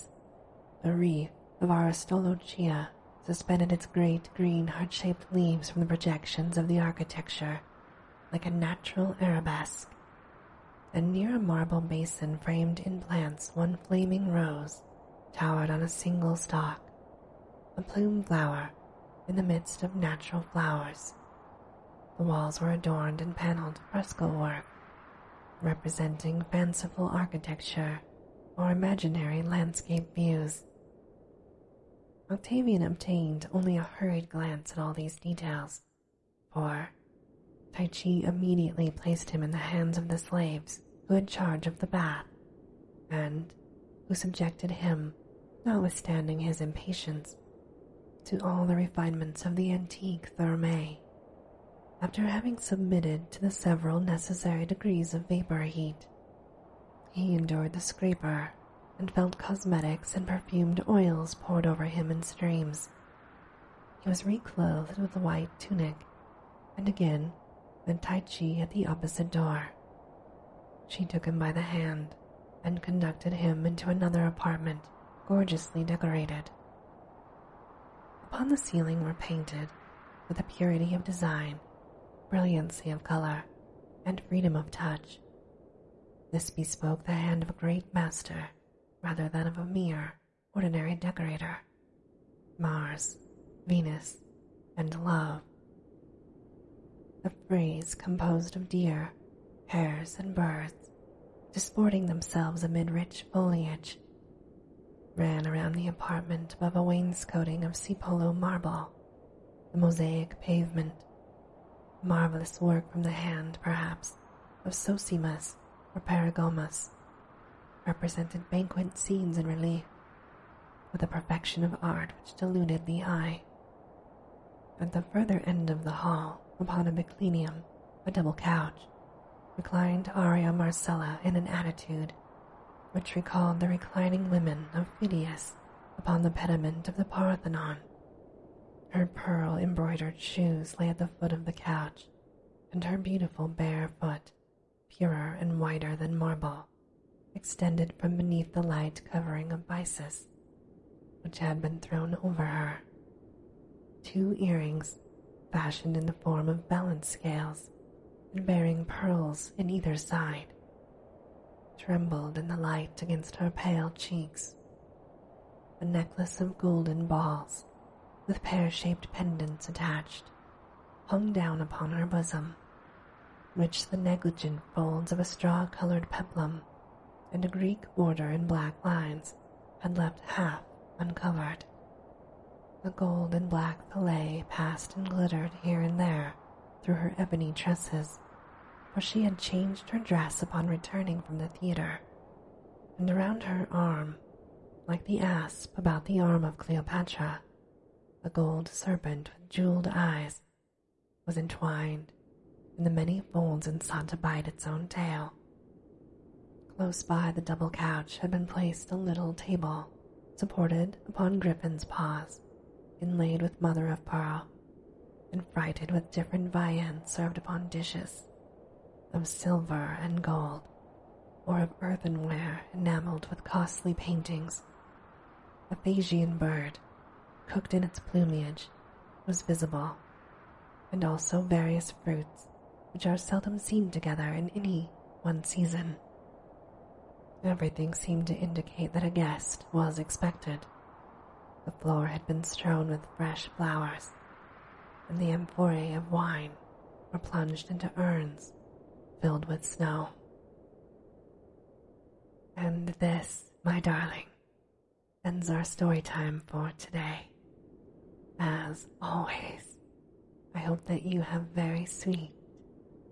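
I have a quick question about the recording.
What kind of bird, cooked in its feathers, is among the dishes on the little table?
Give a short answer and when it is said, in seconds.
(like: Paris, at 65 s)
Phasian bird, at 225 s.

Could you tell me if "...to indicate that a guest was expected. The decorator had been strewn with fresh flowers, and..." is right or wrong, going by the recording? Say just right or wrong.
wrong.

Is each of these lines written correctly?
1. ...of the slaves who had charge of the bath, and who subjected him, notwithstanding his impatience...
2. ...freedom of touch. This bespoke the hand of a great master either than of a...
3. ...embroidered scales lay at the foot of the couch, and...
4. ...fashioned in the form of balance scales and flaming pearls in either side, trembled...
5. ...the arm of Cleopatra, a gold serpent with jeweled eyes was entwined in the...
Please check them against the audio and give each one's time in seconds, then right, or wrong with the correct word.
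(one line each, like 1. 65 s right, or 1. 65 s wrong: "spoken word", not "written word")
1. 39 s right
2. 84 s wrong: "rather", not "either"
3. 139 s wrong: "shoes", not "scales"
4. 155 s wrong: "bearing", not "flaming"
5. 196 s right.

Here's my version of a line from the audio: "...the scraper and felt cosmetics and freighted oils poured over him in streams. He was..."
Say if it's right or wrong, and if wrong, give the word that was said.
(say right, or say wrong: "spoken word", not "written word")
wrong: "perfumed", not "freighted".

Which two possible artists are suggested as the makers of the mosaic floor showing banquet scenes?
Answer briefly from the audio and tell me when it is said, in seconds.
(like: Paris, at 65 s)
Sosimas or Paragomas, at 114 s.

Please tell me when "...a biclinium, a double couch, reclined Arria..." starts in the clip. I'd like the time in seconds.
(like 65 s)
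126 s.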